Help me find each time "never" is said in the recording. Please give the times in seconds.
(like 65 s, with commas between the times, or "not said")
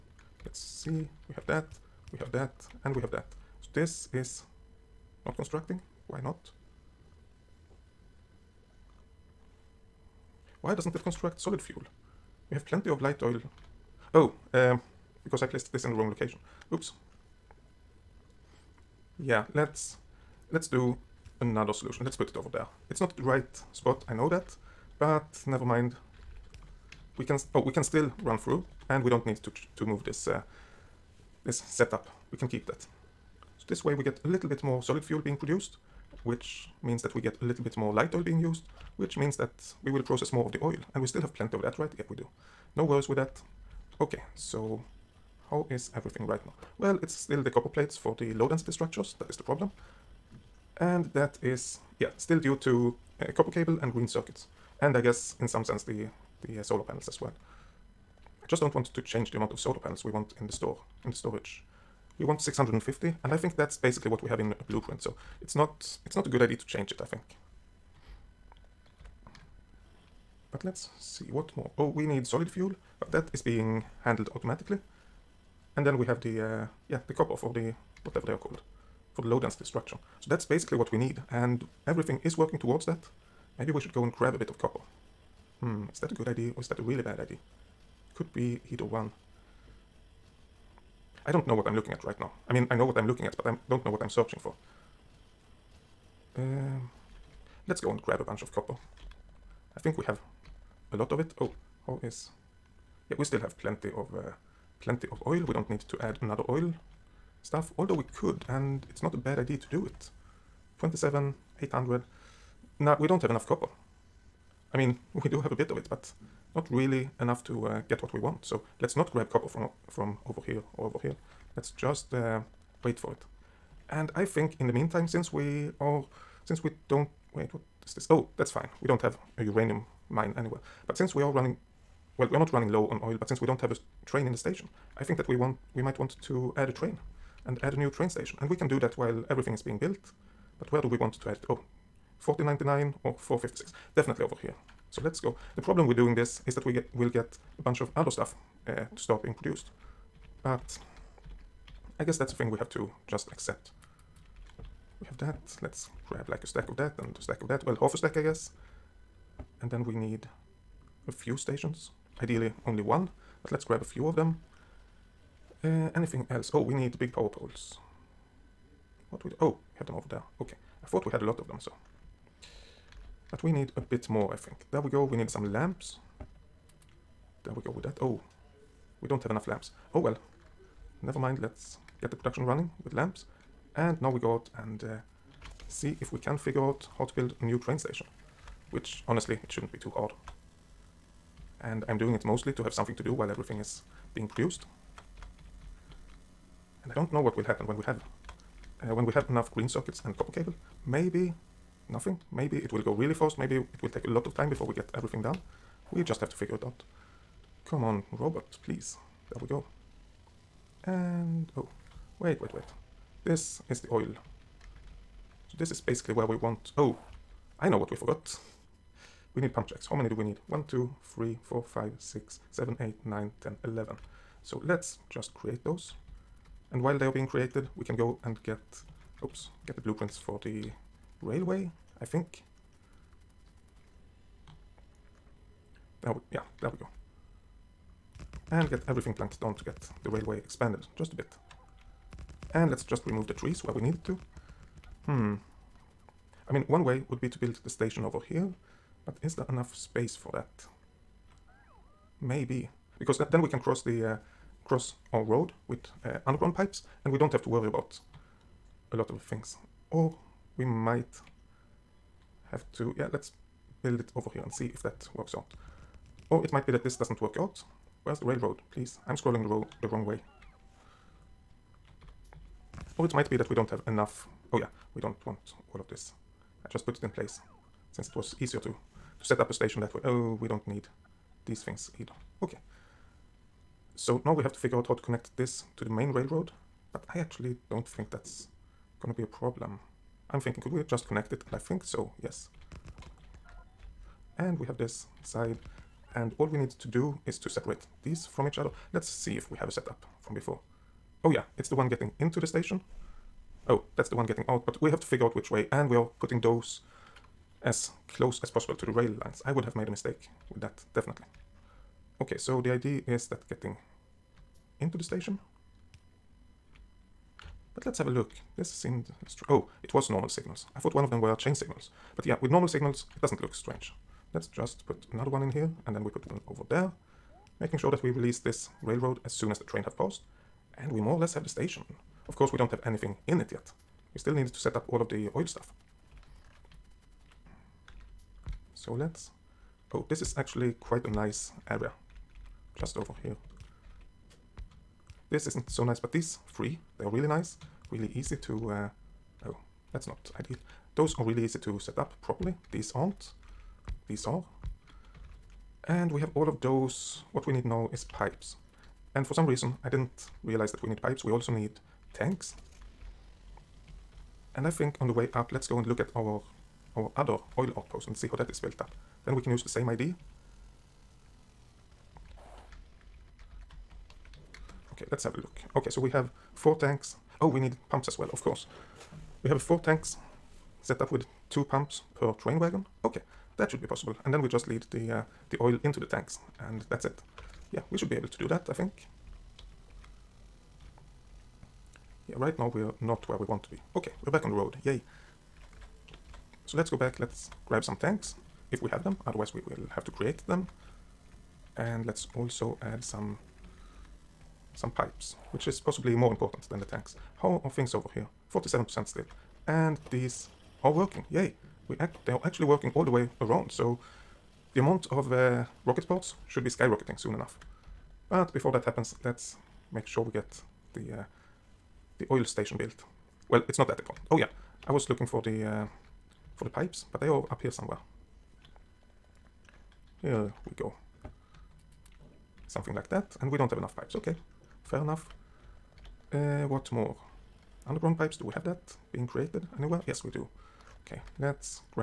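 25 s, 181 s.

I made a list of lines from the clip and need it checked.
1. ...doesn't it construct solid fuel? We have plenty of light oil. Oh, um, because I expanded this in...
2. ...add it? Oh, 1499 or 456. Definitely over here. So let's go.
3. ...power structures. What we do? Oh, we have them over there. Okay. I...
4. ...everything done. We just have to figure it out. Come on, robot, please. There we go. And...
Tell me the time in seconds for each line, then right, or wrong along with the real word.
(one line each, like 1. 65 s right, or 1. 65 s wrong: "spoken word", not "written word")
1. 10 s wrong: "placed", not "expanded"
2. 141 s right
3. 167 s wrong: "poles", not "structures"
4. 204 s right.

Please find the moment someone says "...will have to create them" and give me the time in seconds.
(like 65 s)
399 s.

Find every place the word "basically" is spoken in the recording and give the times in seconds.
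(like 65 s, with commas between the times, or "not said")
63 s, 80 s, 215 s.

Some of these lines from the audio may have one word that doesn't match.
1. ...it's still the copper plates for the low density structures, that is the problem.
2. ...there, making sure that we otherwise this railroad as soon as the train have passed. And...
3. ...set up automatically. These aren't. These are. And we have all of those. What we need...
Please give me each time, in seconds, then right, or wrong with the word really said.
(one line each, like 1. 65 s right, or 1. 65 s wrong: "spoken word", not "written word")
1. 47 s right
2. 326 s wrong: "release", not "otherwise"
3. 351 s wrong: "properly", not "automatically".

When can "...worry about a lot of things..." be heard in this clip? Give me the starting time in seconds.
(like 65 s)
257 s.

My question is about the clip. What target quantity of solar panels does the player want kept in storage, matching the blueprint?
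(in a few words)
650.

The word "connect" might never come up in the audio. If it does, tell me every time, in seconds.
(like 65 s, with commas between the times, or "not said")
285 s, 291 s.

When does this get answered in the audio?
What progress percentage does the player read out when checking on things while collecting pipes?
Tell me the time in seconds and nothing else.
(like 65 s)
408 s.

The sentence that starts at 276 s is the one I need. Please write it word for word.
I just put it in place since it was easier to, to set up a station that way.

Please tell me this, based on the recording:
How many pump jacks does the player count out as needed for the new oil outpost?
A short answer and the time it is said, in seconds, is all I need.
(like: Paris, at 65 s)
11, at 223 s.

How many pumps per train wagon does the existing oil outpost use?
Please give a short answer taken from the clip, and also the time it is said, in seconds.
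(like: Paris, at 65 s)
2, at 381 s.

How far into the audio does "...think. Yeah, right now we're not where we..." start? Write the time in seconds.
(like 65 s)
388 s.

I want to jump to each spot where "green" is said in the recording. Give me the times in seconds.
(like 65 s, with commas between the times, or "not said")
53 s, 199 s.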